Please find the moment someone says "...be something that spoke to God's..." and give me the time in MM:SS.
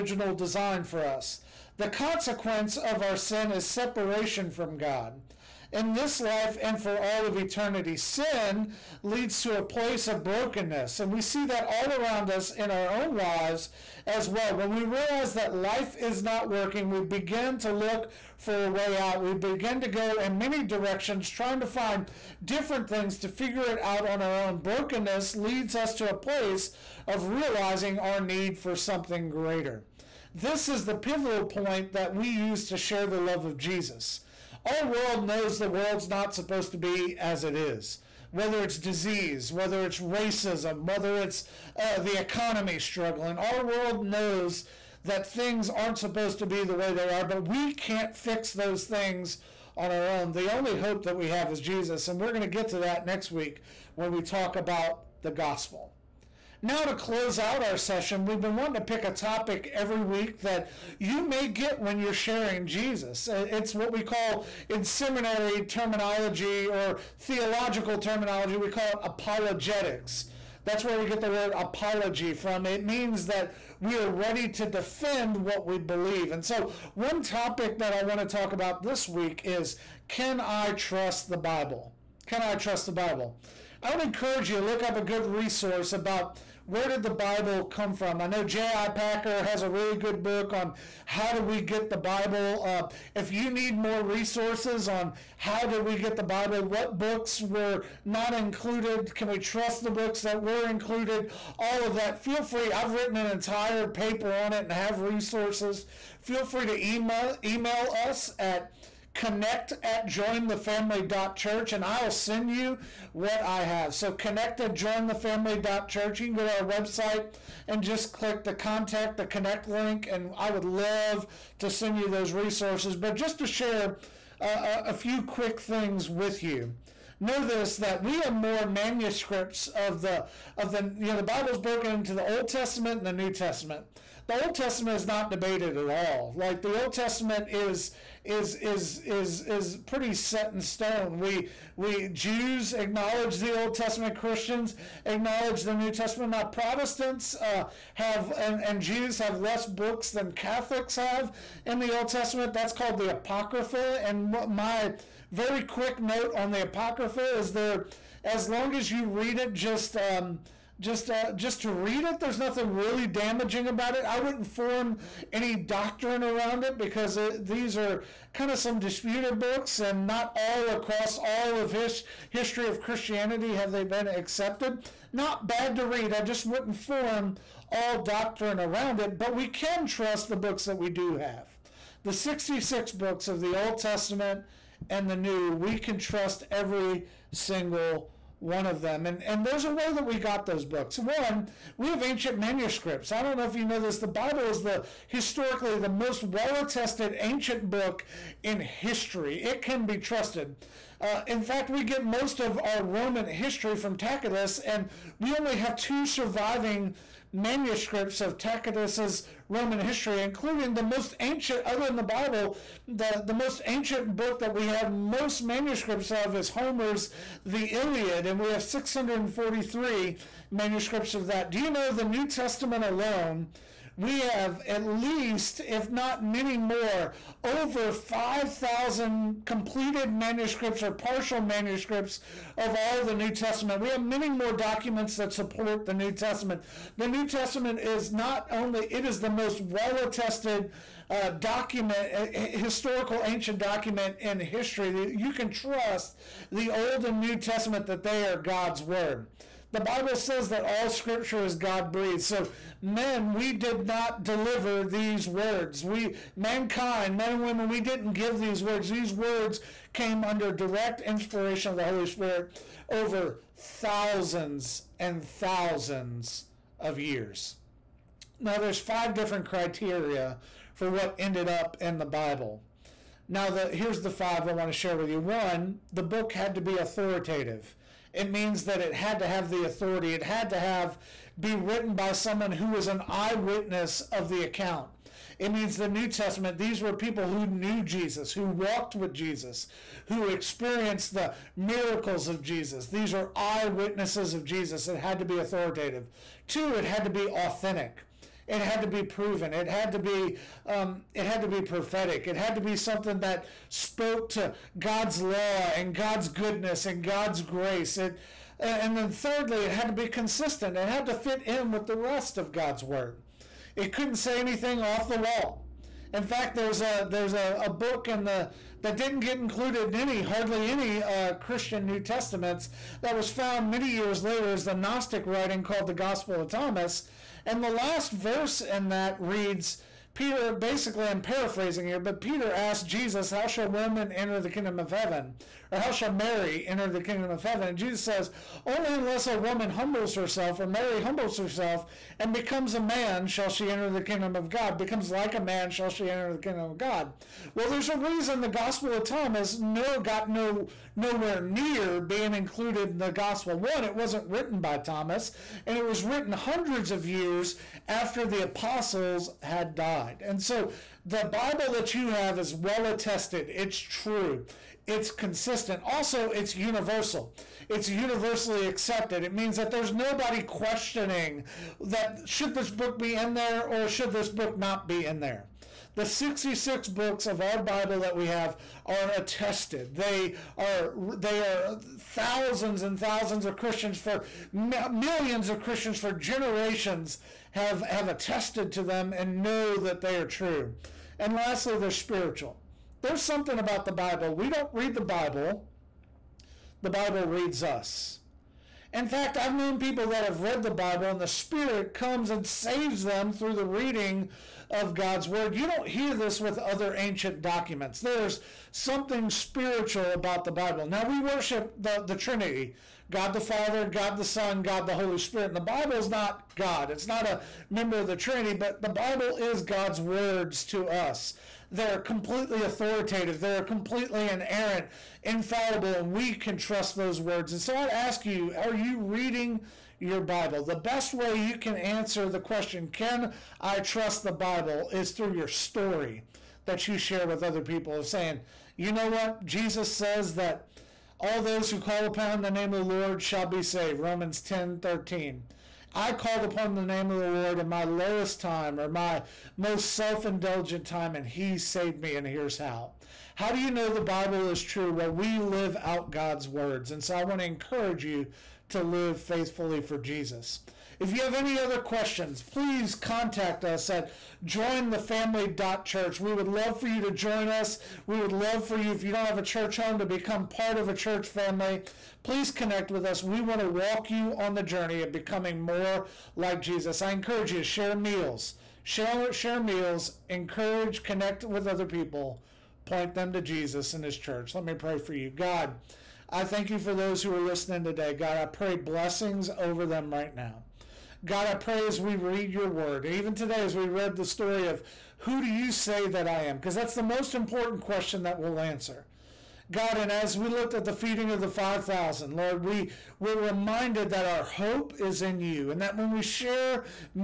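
05:02.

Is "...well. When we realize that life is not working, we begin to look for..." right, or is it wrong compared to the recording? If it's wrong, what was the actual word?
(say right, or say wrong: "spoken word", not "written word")
right.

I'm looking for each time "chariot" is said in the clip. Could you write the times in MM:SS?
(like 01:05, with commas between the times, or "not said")
not said.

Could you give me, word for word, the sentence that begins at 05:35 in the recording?
or how shall Mary enter the kingdom of heaven?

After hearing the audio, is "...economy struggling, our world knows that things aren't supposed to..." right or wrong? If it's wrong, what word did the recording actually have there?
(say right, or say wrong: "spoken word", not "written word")
right.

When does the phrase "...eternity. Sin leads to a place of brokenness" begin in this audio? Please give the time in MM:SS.
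00:07.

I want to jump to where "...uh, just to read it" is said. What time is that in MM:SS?
02:41.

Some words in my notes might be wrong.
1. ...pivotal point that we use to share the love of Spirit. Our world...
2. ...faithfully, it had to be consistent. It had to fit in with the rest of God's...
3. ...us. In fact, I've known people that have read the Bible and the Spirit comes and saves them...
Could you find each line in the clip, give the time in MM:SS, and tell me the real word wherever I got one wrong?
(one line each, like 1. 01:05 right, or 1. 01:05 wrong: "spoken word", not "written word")
1. 00:30 wrong: "Jesus", not "Spirit"
2. 05:09 wrong: "thirdly", not "faithfully"
3. 06:37 right.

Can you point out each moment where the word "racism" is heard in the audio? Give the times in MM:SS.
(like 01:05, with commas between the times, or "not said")
00:40.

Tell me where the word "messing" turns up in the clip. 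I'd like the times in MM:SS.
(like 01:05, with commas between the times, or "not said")
not said.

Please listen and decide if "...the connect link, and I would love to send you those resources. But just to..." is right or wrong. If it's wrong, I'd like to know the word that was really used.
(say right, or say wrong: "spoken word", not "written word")
right.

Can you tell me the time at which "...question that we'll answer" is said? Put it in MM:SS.
08:17.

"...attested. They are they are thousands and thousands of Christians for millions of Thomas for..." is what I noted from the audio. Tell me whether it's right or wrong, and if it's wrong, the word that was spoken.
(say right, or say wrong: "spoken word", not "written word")
wrong: "Christians", not "Thomas".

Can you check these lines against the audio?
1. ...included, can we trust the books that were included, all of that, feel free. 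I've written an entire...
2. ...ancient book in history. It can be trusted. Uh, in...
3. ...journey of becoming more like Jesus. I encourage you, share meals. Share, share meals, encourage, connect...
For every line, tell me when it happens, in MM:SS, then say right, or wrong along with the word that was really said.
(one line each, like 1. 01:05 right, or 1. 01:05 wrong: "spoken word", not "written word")
1. 01:38 right
2. 03:17 right
3. 07:54 right.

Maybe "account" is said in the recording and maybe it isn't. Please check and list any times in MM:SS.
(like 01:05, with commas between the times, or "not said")
04:44.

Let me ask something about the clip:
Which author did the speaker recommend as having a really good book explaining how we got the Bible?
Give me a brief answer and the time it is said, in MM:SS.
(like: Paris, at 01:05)
J.I. Packer, at 01:28.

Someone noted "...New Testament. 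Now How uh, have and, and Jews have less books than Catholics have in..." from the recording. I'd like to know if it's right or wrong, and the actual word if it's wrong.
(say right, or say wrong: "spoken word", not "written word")
wrong: "Protestants", not "How".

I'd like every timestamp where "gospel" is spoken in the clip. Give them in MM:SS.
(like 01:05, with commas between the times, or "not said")
00:55, 05:25, 05:48, 05:53.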